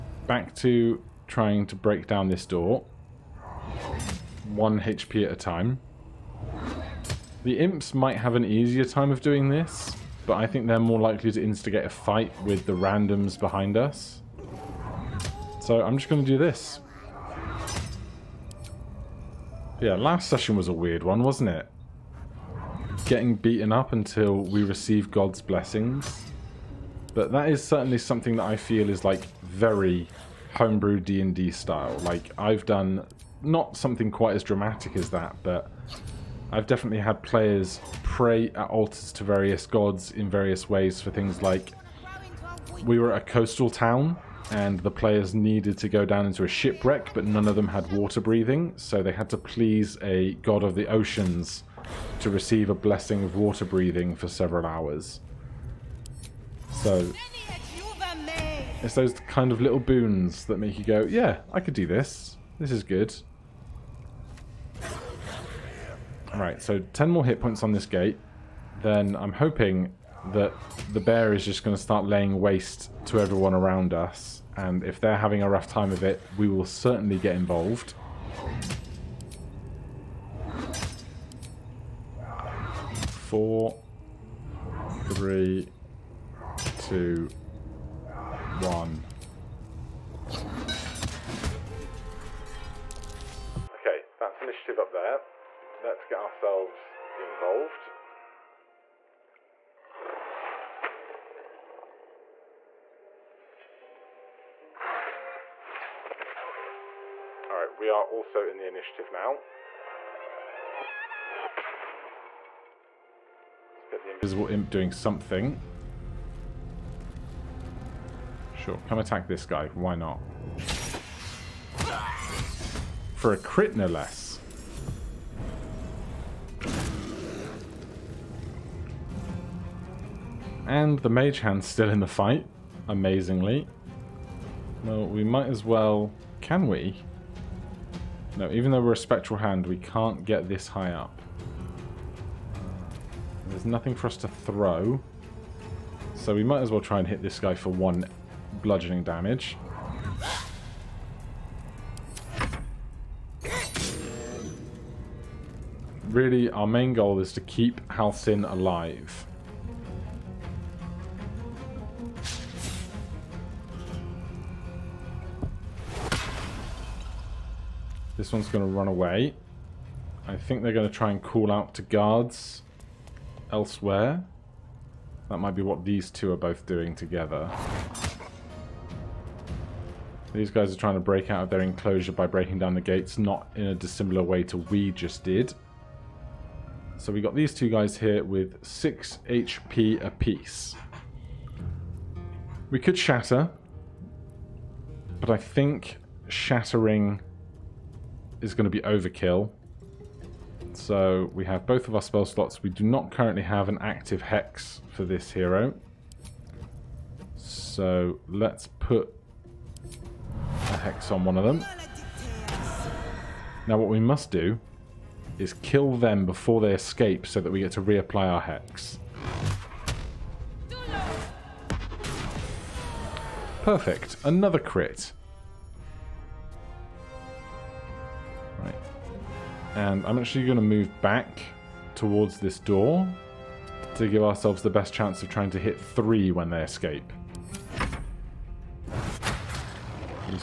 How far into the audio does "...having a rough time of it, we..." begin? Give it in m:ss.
1:15.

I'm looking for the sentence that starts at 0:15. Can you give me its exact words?
So I'm just going to do this.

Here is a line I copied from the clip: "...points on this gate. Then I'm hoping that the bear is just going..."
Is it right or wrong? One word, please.
right.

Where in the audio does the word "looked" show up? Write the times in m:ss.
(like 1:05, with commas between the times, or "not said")
not said.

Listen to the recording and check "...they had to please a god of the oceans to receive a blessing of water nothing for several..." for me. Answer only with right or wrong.
wrong.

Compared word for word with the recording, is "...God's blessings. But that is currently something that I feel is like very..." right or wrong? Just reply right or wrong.
wrong.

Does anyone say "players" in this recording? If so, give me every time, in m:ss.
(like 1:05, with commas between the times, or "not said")
0:37, 0:44.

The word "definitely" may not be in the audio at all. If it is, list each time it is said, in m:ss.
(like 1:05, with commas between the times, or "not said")
0:36.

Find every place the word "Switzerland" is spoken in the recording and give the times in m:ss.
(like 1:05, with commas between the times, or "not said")
not said.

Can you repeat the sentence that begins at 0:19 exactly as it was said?
Yeah, last session was a weird one, wasn't it?